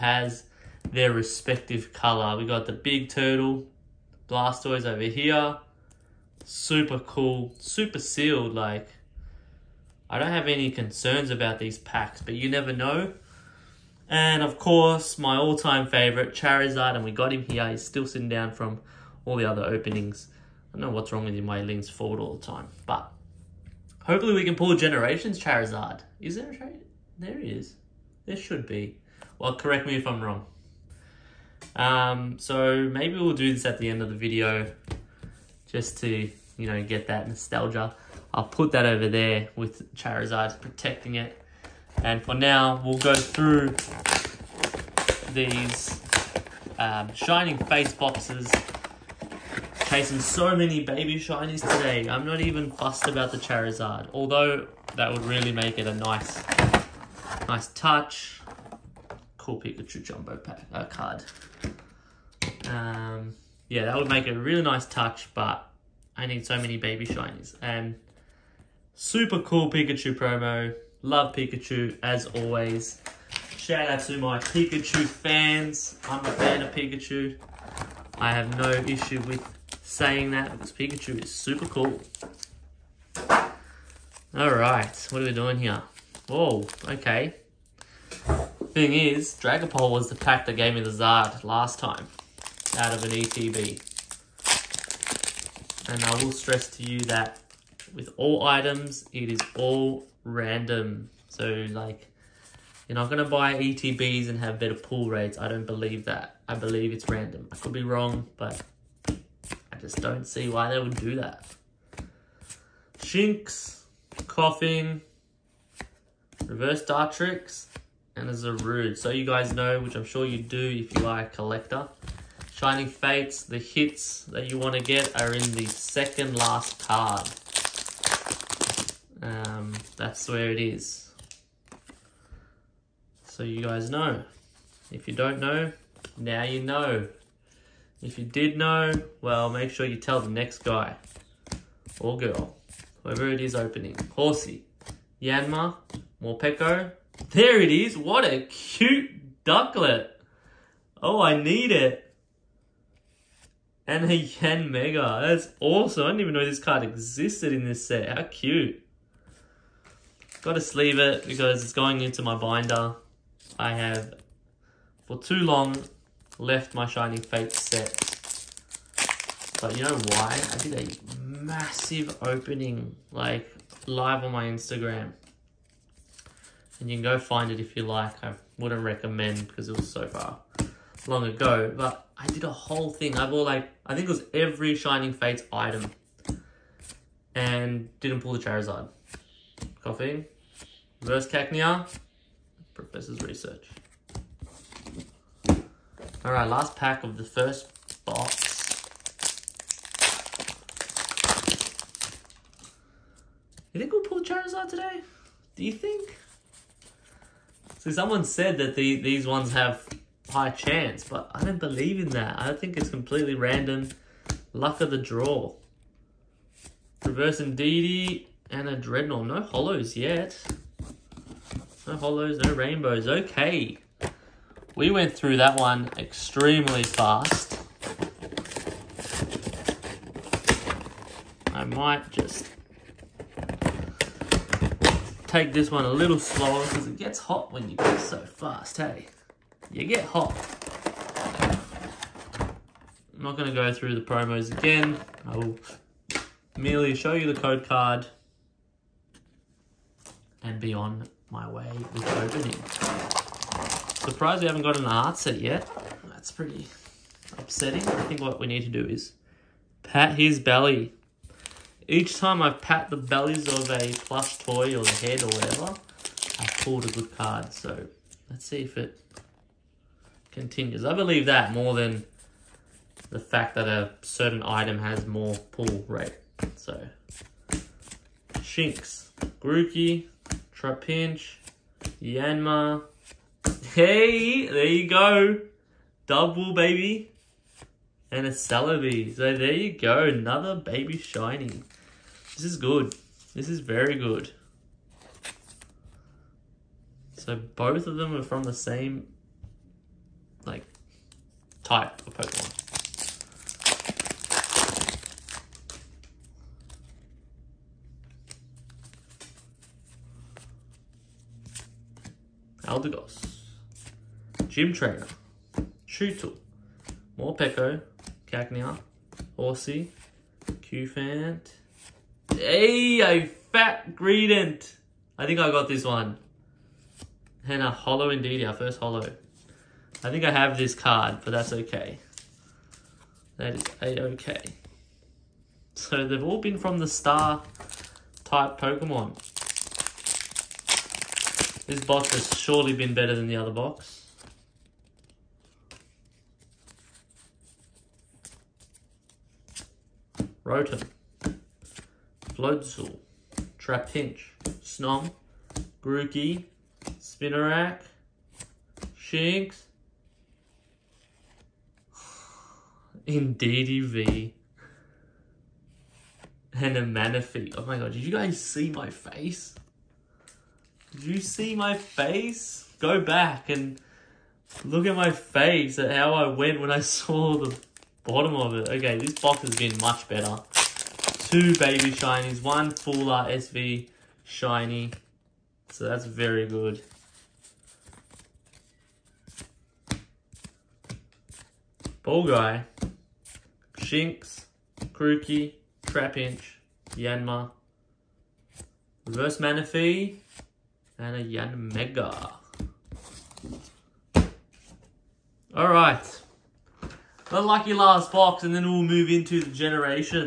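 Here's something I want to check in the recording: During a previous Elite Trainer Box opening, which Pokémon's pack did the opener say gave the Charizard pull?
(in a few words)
Dragapult.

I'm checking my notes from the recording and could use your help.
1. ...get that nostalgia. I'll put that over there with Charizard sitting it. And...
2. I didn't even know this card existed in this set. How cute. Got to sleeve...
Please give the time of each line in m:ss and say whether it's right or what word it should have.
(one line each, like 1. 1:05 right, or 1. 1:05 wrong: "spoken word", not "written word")
1. 0:36 wrong: "protecting", not "sitting"
2. 2:36 right.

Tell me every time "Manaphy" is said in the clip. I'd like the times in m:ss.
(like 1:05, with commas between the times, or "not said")
6:06, 6:39.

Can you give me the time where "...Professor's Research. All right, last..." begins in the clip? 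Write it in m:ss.
3:12.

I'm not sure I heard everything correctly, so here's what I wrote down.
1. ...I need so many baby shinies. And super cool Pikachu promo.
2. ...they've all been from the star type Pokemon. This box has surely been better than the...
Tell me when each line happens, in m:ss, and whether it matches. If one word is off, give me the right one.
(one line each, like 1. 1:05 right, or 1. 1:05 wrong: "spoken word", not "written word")
1. 1:06 right
2. 5:36 right.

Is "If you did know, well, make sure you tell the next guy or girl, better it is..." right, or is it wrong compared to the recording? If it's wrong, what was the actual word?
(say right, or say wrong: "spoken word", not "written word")
wrong: "whoever", not "better".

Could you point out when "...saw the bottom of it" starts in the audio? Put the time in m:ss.
6:16.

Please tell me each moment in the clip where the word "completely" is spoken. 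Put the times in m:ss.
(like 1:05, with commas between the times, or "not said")
3:32.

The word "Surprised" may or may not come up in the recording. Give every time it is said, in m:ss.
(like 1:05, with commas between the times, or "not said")
4:13.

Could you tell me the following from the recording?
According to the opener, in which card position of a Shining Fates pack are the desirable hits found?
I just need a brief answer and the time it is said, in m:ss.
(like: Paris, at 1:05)
Second last card, at 2:05.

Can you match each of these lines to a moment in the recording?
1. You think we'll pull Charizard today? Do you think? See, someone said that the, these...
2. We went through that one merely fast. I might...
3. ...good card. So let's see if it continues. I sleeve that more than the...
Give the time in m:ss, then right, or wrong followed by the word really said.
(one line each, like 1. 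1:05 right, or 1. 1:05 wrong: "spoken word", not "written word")
1. 3:23 right
2. 3:44 wrong: "extremely", not "merely"
3. 4:26 wrong: "believe", not "sleeve".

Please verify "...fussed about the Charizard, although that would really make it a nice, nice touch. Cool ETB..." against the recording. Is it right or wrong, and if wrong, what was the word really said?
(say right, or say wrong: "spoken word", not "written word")
wrong: "Pikachu", not "ETB".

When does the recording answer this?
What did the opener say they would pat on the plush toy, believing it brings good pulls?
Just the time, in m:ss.
4:19.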